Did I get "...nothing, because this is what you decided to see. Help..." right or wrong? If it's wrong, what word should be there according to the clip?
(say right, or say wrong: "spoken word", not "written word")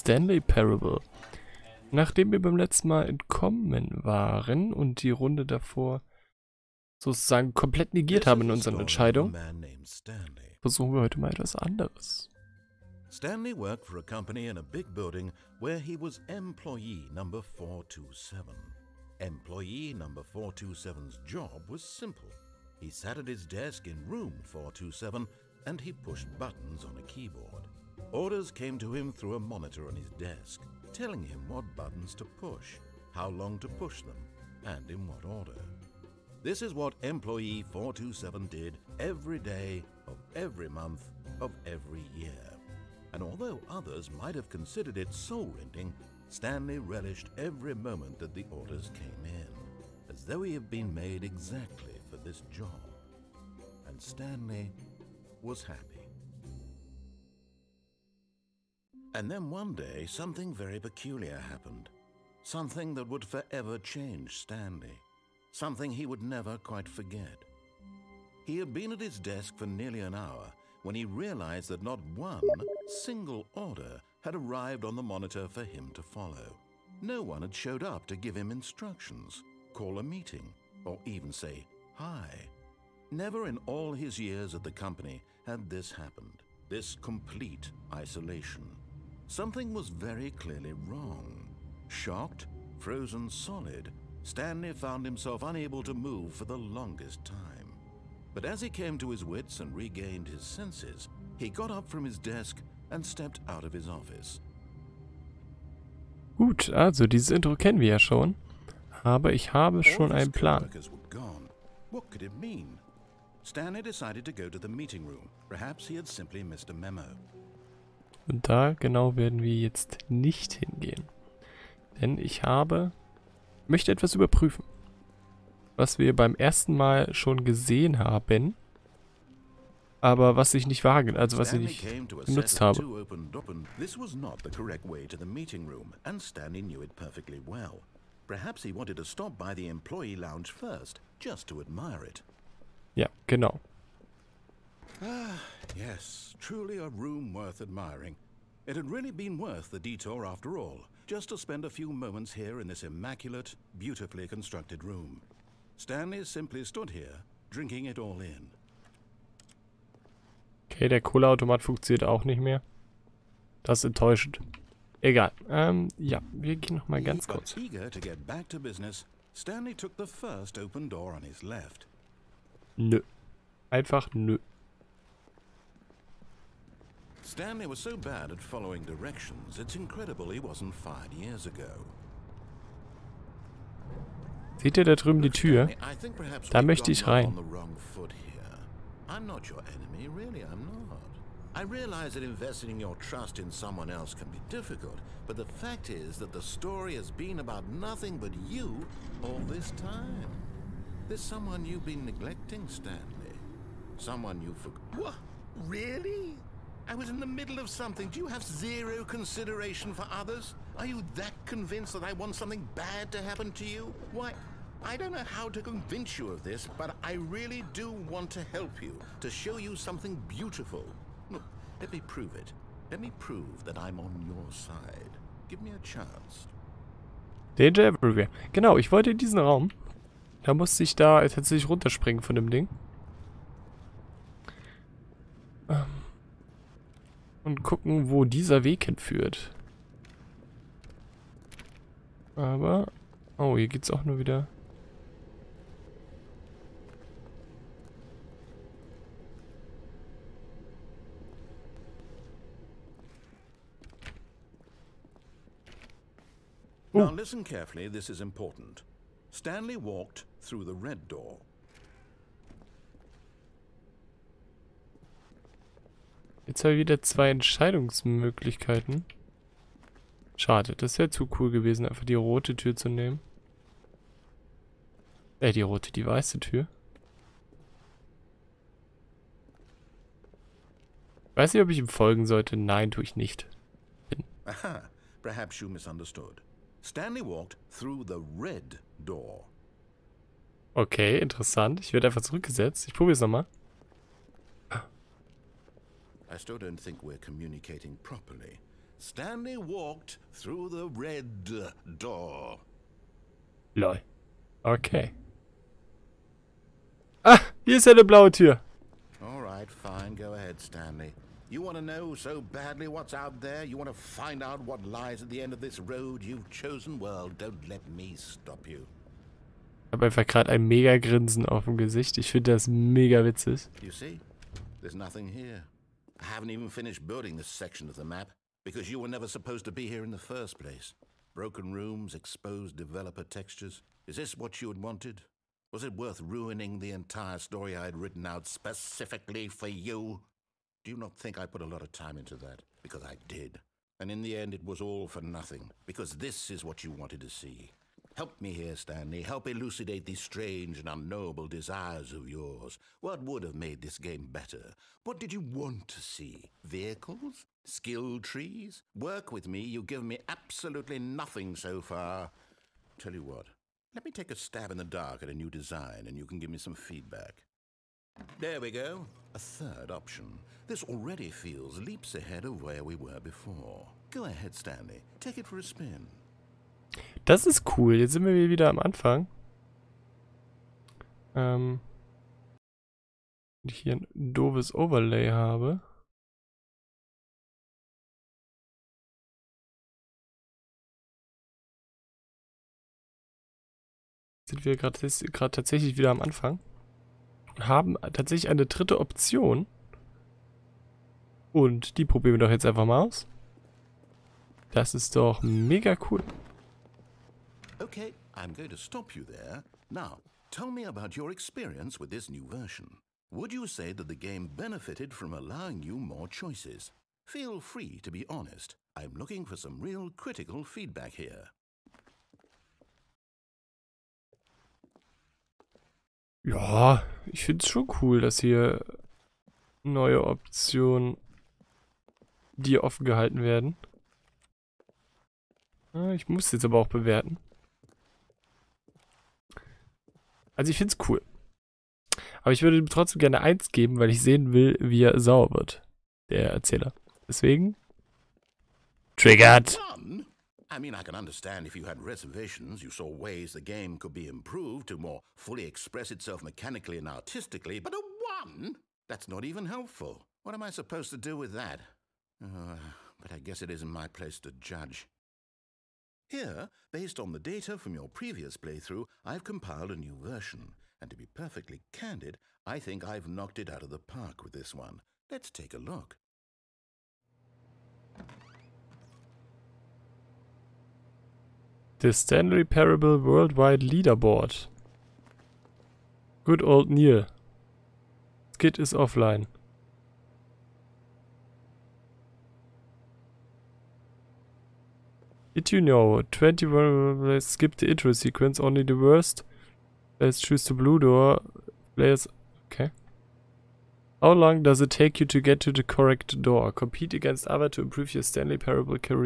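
wrong: "wanted", not "decided".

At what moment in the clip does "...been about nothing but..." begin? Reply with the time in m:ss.
3:17.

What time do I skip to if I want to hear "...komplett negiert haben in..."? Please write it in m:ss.
0:07.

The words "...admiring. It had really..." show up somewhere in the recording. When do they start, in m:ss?
2:27.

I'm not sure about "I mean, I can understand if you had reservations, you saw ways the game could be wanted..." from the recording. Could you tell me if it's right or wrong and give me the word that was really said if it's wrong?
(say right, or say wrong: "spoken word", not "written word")
wrong: "improved", not "wanted".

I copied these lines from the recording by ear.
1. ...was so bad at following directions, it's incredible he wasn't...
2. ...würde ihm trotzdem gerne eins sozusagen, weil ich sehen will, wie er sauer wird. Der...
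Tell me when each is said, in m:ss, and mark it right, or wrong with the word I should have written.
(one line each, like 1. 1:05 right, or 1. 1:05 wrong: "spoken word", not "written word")
1. 2:57 right
2. 7:22 wrong: "geben", not "sozusagen".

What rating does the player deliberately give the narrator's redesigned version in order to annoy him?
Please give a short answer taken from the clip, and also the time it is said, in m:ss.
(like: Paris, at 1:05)
1, at 7:37.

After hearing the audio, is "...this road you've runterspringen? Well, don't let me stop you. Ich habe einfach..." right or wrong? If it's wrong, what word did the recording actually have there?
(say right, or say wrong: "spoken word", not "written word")
wrong: "chosen", not "runterspringen".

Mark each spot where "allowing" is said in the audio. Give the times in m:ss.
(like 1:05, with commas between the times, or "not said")
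6:55.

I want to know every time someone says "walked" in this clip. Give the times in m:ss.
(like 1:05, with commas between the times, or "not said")
4:19, 4:47, 4:59.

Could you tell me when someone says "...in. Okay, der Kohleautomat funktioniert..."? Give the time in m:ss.
2:38.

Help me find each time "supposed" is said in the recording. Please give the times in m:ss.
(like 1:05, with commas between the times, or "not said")
5:29, 7:40.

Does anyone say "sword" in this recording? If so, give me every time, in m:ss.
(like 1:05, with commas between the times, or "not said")
not said.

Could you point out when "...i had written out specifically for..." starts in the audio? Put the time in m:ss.
5:37.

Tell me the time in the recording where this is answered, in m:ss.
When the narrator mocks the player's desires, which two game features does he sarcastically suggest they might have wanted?
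5:56.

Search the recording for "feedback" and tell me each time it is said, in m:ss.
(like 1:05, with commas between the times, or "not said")
6:06, 7:00.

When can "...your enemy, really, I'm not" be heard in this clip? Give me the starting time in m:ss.
3:09.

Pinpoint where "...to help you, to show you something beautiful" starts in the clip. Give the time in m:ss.
3:38.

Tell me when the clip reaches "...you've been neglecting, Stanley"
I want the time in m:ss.
3:21.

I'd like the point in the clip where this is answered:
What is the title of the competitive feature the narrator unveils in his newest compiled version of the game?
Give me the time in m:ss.
8:01.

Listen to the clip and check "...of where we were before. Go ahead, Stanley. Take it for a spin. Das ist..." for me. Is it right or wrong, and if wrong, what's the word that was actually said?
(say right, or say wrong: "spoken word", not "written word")
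right.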